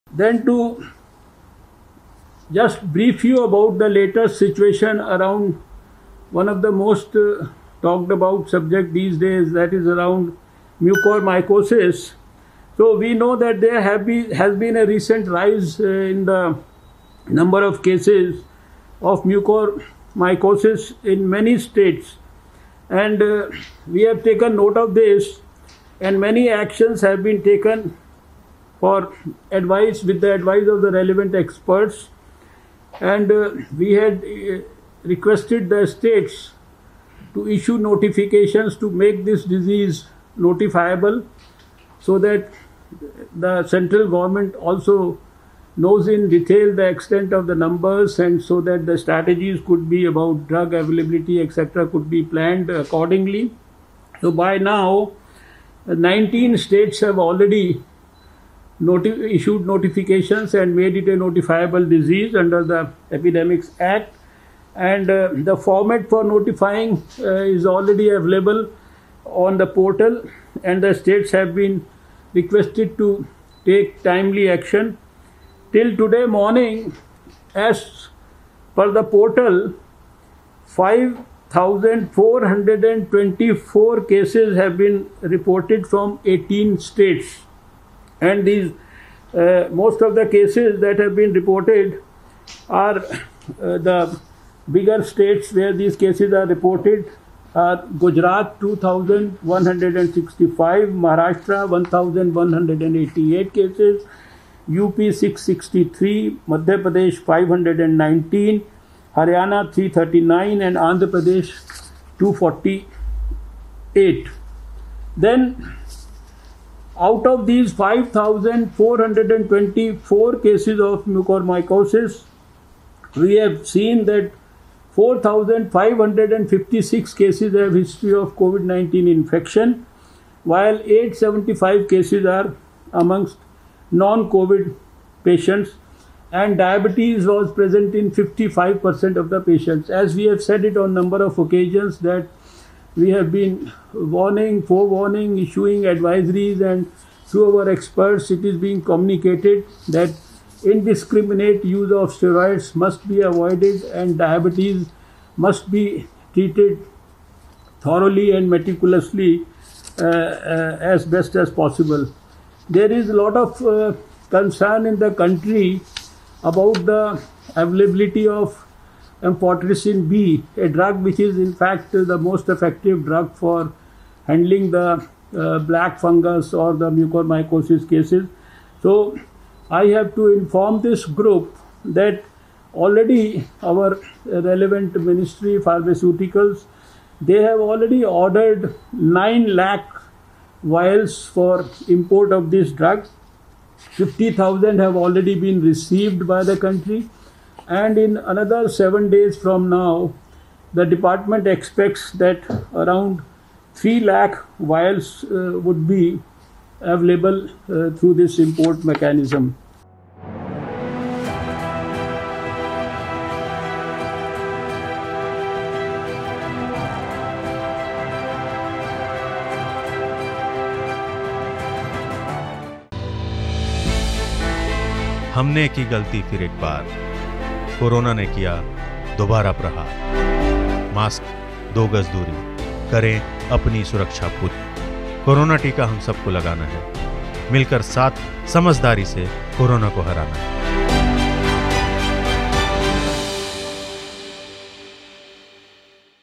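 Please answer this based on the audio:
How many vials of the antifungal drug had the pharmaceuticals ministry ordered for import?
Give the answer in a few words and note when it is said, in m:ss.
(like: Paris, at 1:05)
9 lakh, at 3:08.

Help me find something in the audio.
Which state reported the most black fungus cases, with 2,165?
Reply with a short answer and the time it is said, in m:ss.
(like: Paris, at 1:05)
Gujarat, at 1:37.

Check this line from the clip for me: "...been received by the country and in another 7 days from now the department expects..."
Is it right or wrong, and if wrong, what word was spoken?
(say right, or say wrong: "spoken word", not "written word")
right.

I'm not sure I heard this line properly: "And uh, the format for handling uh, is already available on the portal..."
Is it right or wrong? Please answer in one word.
wrong.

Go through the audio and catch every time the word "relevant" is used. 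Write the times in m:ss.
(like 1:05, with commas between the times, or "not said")
0:30, 3:04.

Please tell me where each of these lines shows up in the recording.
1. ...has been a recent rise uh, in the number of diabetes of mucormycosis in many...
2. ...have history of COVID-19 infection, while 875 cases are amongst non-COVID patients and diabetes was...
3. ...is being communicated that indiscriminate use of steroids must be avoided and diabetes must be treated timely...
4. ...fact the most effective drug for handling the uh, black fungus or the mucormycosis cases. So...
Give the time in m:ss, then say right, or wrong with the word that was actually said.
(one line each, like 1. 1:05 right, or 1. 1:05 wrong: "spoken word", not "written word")
1. 0:14 wrong: "cases", not "diabetes"
2. 2:07 right
3. 2:28 wrong: "thoroughly", not "timely"
4. 2:51 right.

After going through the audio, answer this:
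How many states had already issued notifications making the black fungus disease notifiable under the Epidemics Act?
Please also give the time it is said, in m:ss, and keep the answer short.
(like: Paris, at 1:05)
19, at 0:55.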